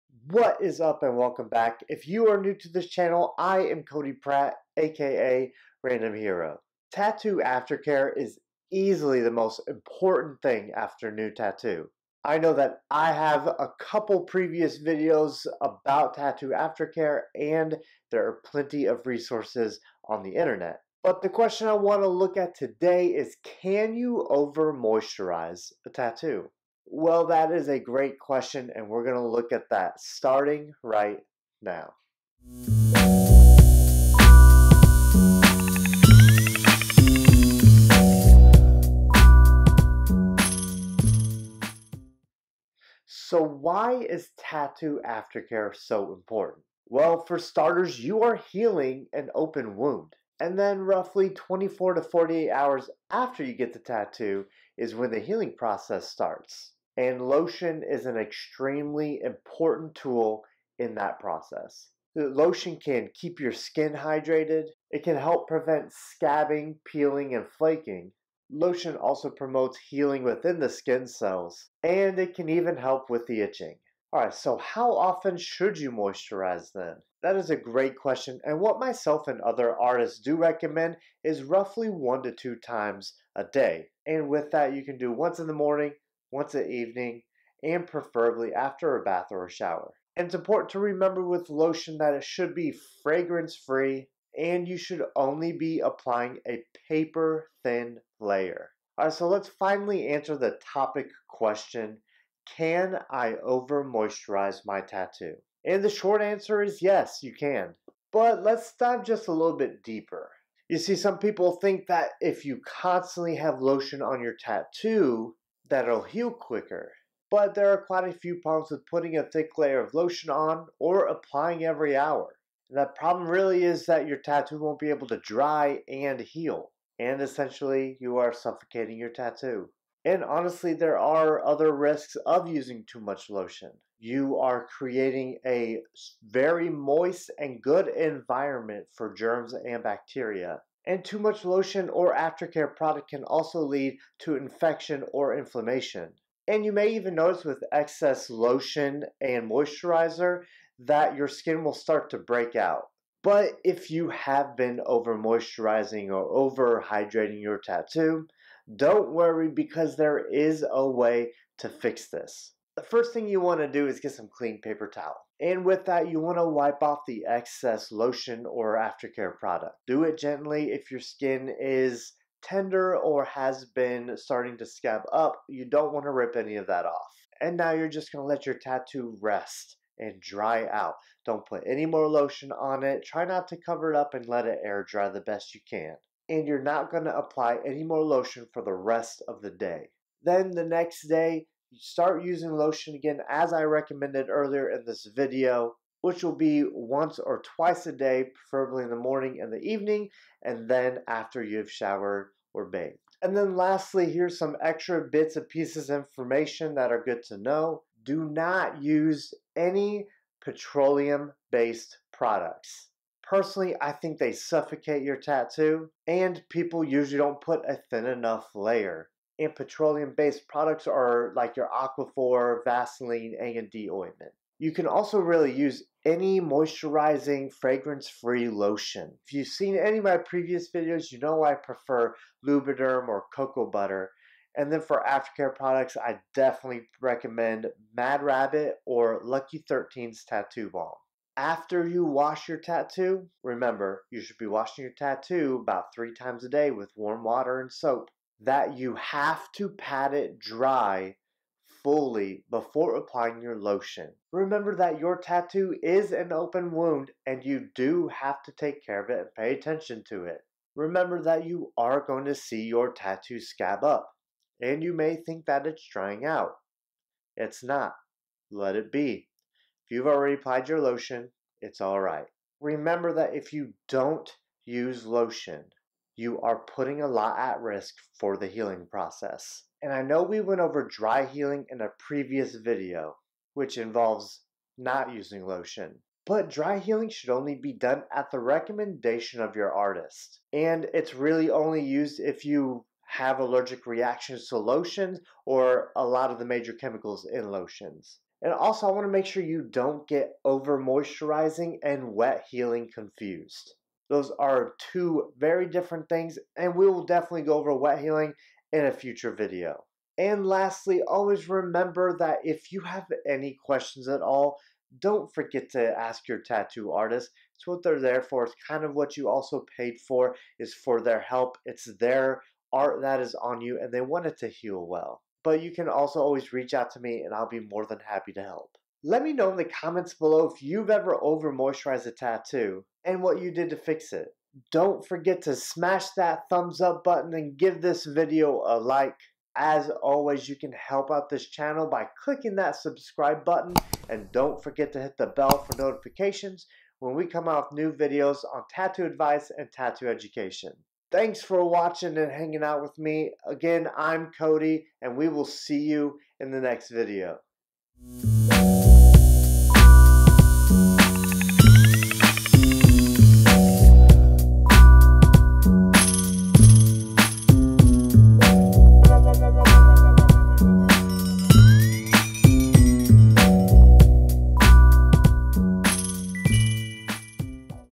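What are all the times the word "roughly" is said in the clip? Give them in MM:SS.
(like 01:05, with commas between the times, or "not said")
00:50, 01:21.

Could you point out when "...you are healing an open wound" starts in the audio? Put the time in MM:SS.
00:48.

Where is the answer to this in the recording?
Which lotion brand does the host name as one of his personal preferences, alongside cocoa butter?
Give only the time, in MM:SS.
03:52.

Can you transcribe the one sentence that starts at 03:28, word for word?
Do not use any petroleum-based products.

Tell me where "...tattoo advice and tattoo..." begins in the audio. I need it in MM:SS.
05:48.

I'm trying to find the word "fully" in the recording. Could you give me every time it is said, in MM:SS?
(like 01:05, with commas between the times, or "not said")
04:11.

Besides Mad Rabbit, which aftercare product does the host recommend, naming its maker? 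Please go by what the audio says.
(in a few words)
Lucky 13's Tattoo Balm.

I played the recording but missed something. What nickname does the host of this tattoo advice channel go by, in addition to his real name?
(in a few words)
Random Hero.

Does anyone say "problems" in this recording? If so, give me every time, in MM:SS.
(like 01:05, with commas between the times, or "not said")
01:58, 02:02.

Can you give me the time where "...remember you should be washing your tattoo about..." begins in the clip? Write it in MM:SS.
04:03.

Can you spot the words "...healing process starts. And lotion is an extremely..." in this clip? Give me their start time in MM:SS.
00:55.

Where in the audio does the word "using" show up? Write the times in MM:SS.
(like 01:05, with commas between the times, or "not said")
02:12, 03:12, 04:45.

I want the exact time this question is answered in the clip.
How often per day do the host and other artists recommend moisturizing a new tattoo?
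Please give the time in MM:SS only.
01:21.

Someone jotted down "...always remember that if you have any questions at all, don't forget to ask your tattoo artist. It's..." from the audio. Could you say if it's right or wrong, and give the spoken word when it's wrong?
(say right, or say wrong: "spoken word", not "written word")
right.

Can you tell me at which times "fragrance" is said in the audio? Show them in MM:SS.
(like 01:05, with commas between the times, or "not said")
01:33, 03:47.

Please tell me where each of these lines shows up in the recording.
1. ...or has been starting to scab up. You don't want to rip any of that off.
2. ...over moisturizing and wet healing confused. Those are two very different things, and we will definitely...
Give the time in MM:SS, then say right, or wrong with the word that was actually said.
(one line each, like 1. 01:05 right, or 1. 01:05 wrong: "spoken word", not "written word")
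1. 02:52 right
2. 05:00 right.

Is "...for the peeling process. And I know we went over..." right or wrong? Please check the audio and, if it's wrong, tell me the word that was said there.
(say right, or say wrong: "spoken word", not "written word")
wrong: "healing", not "peeling".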